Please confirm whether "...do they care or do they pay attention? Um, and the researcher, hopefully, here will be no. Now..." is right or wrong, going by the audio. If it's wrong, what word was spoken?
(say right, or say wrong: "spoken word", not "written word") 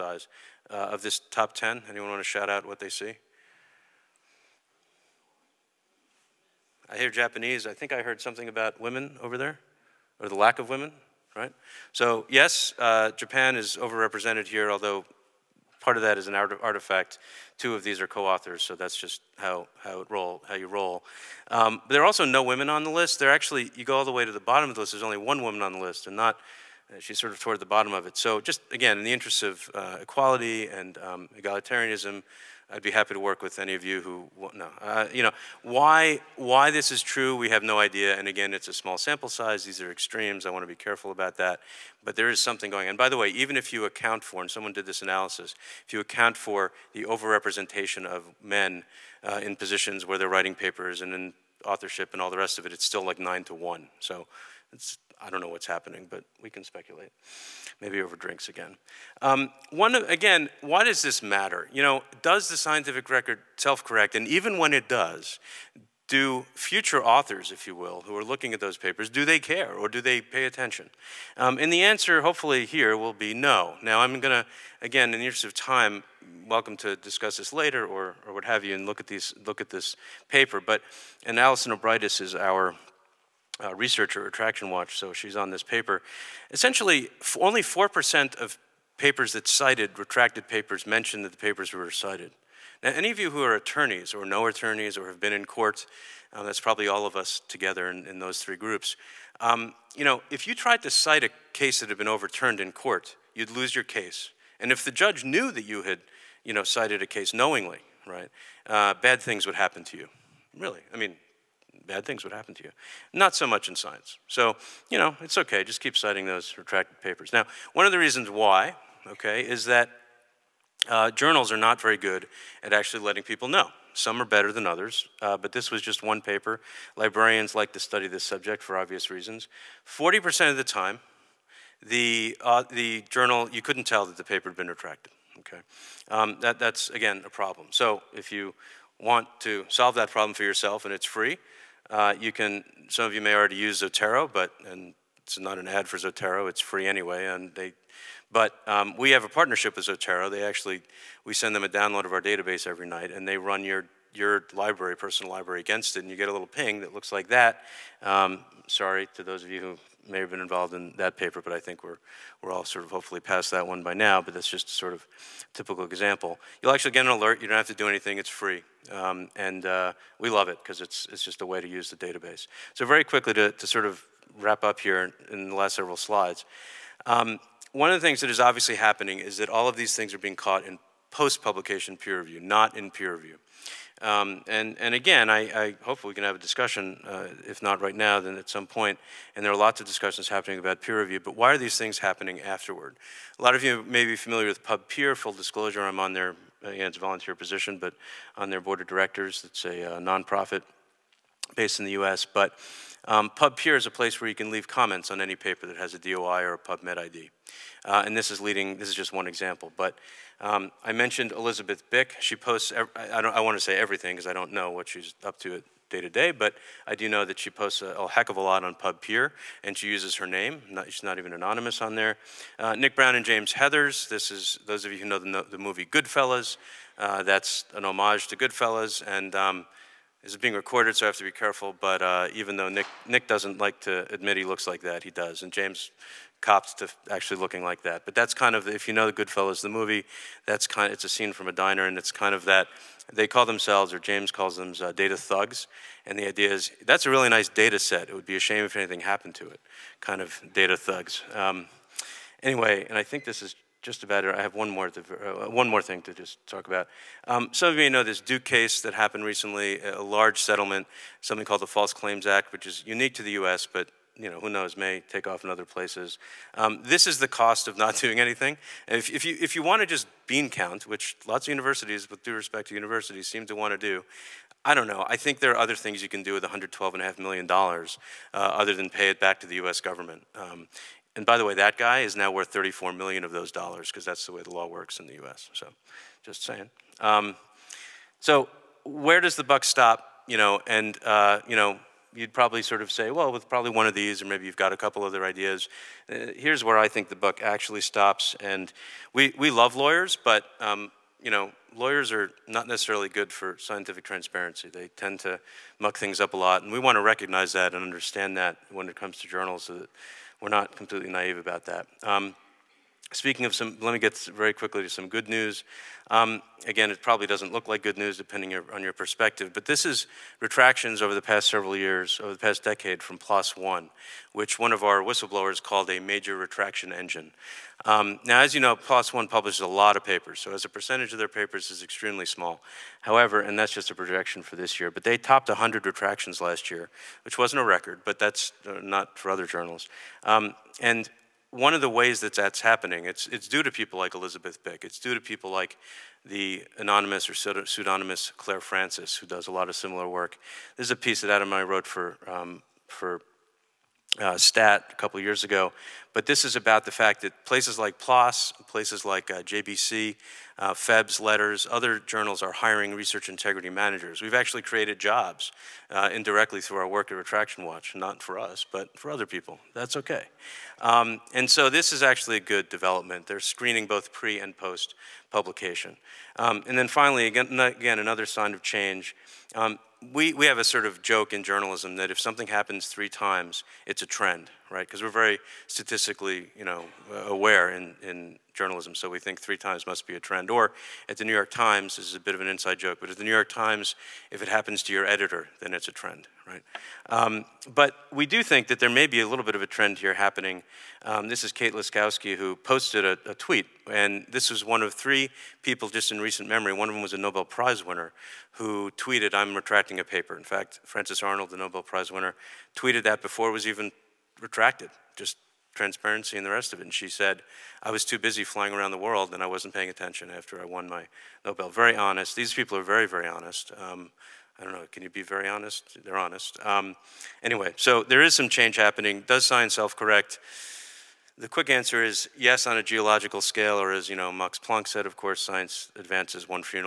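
wrong: "answer", not "researcher".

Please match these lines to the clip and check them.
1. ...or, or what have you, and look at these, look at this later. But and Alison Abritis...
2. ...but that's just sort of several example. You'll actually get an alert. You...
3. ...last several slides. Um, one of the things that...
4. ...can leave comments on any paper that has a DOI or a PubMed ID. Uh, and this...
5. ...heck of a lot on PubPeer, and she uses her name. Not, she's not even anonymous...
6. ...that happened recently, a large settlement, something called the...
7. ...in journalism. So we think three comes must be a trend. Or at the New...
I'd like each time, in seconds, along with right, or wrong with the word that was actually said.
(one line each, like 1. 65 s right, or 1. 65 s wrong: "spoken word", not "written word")
1. 77 s wrong: "paper", not "later"
2. 164 s wrong: "typical", not "several"
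3. 175 s right
4. 204 s right
5. 218 s right
6. 258 s right
7. 388 s wrong: "times", not "comes".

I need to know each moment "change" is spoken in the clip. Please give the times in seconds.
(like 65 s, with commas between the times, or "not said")
378 s, 428 s.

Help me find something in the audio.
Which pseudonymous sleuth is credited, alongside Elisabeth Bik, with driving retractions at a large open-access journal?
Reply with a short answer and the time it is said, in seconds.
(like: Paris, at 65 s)
Clare Francis, at 348 s.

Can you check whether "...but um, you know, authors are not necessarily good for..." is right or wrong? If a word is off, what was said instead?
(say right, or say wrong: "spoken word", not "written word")
wrong: "lawyers", not "authors".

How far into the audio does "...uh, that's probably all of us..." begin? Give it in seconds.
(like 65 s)
96 s.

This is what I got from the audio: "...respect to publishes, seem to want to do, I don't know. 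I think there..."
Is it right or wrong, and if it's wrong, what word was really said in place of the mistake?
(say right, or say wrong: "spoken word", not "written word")
wrong: "universities", not "publishes".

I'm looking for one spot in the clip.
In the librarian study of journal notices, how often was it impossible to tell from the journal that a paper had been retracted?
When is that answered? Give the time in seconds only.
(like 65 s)
129 s.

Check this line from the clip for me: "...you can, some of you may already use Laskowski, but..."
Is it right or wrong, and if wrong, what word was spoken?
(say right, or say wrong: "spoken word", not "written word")
wrong: "Zotero", not "Laskowski".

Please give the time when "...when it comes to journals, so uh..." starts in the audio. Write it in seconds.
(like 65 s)
308 s.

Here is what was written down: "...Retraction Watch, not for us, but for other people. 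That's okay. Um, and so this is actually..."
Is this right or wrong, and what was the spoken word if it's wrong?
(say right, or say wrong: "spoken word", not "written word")
right.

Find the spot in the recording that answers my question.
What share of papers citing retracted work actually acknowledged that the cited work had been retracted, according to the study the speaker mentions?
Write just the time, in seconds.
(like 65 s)
87 s.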